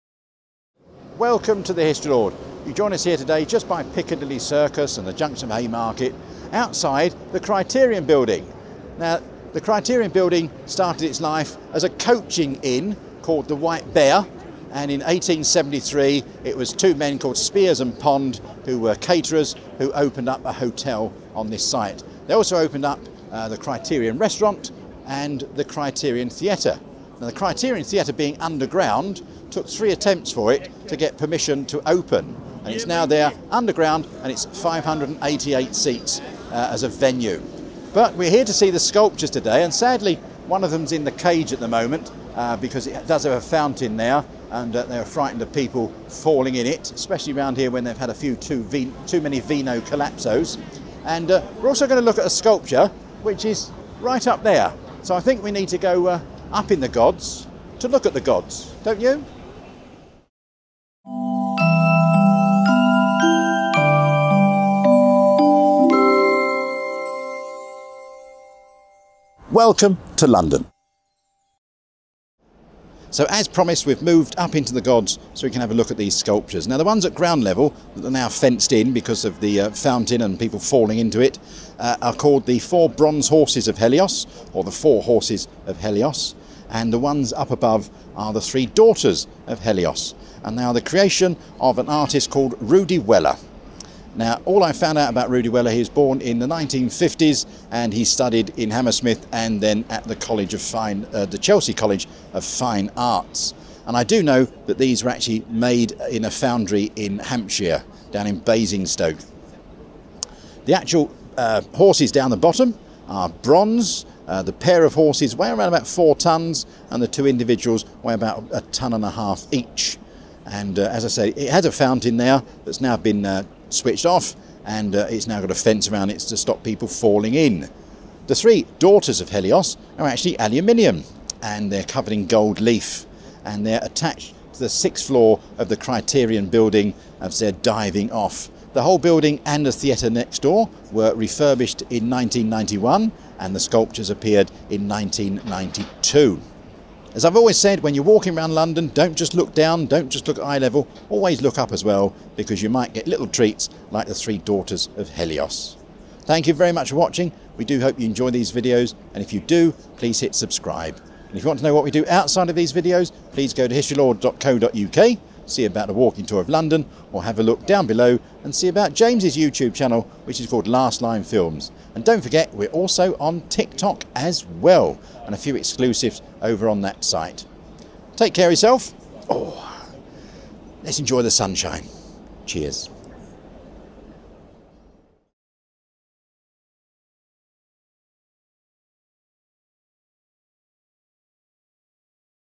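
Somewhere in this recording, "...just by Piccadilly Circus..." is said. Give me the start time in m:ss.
0:03.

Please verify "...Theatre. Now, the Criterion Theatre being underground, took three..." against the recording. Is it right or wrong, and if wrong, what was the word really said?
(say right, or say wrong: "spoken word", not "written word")
right.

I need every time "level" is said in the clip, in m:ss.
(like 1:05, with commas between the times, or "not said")
1:17, 2:30.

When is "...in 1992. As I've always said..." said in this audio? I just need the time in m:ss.
2:24.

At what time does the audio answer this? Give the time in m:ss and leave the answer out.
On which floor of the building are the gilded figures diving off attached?
2:14.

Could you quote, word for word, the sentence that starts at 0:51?
And uh, we're also going to look at a sculpture which is right up there.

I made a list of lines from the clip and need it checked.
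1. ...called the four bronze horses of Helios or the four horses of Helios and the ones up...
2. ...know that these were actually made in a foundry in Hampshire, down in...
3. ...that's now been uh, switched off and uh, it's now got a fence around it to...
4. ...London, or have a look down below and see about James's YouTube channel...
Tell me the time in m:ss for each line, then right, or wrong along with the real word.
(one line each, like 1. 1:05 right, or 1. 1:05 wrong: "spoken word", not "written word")
1. 1:22 right
2. 1:44 right
3. 2:02 right
4. 2:46 right.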